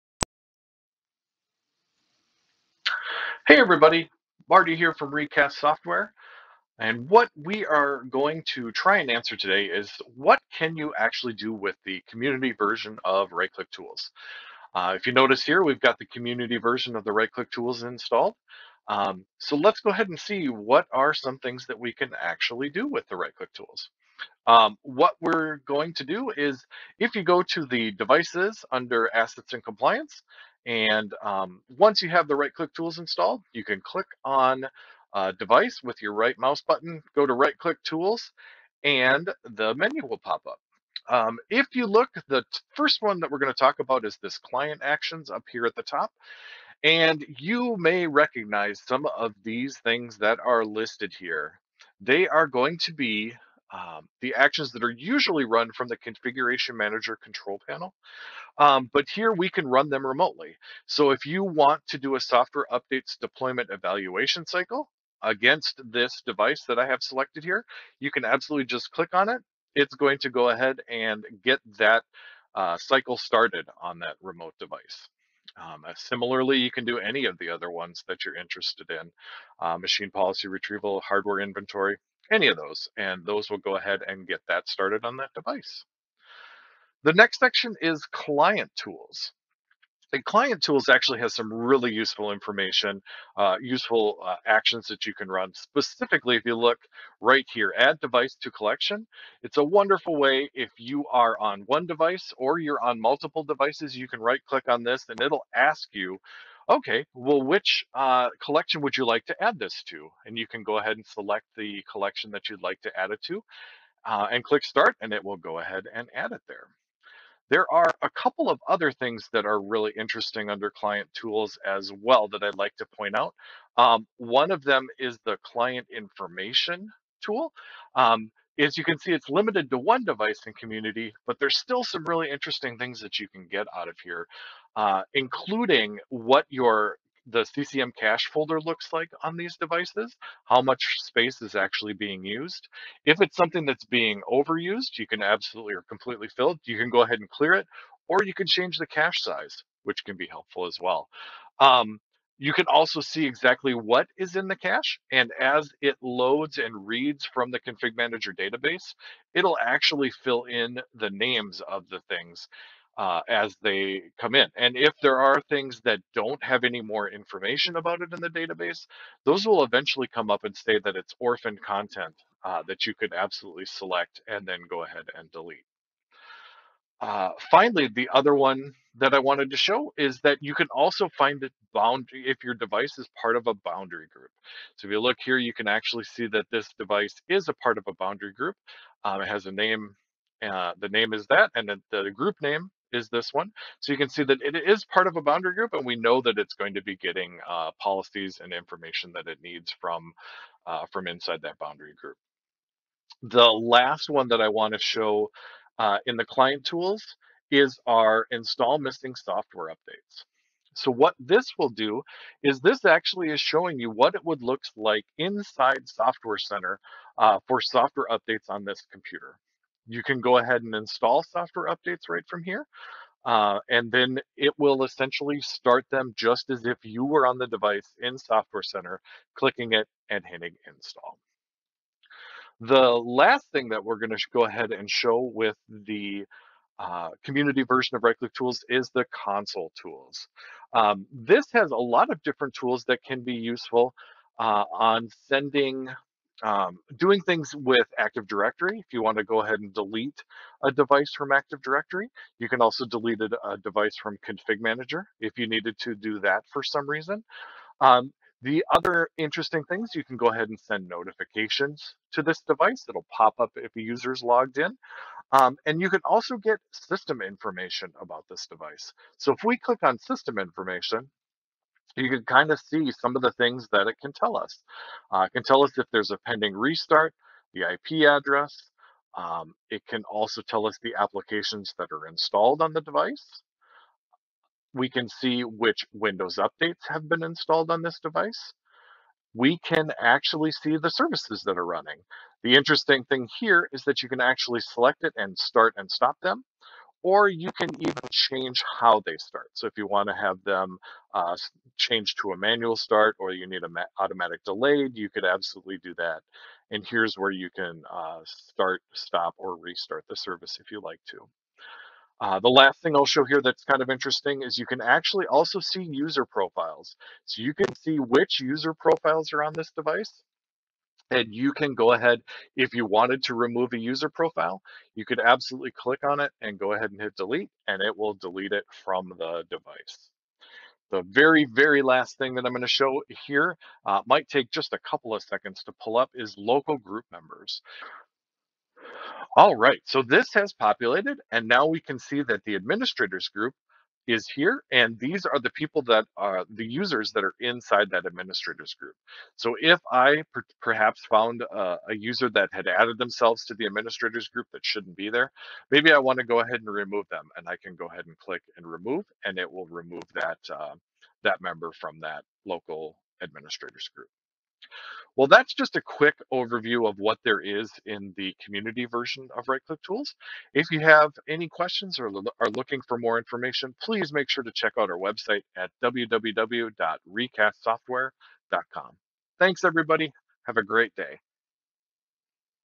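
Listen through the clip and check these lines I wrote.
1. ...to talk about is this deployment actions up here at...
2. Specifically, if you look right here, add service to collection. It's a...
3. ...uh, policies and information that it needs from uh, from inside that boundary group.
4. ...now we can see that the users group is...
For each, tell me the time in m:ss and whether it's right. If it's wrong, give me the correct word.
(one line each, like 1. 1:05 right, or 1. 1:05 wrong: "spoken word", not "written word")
1. 0:43 wrong: "client", not "deployment"
2. 1:35 wrong: "device", not "service"
3. 3:17 right
4. 5:41 wrong: "administrators", not "users".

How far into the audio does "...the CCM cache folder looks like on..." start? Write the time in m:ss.
2:17.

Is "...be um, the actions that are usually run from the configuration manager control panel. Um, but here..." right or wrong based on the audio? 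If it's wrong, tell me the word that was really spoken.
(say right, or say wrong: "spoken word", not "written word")
right.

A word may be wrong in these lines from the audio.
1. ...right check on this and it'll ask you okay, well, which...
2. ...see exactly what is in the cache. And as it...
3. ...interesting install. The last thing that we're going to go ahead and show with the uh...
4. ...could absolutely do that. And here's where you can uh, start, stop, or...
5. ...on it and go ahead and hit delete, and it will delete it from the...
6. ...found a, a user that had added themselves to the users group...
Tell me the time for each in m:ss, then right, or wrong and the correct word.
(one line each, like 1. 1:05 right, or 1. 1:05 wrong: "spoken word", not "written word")
1. 1:44 wrong: "click", not "check"
2. 2:33 right
3. 3:50 wrong: "hitting", not "interesting"
4. 5:05 right
5. 5:26 right
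6. 5:51 wrong: "administrators", not "users".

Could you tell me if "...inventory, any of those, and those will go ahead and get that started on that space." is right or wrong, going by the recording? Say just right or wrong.
wrong.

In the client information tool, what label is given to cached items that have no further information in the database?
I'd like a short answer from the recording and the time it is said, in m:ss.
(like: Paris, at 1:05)
orphan content, at 2:51.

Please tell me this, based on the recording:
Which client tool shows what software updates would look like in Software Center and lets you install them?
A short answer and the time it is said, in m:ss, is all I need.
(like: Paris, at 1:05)
install missing software updates, at 3:28.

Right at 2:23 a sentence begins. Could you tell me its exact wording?
If it's something that's being overused, you can absolutely or completely fill it.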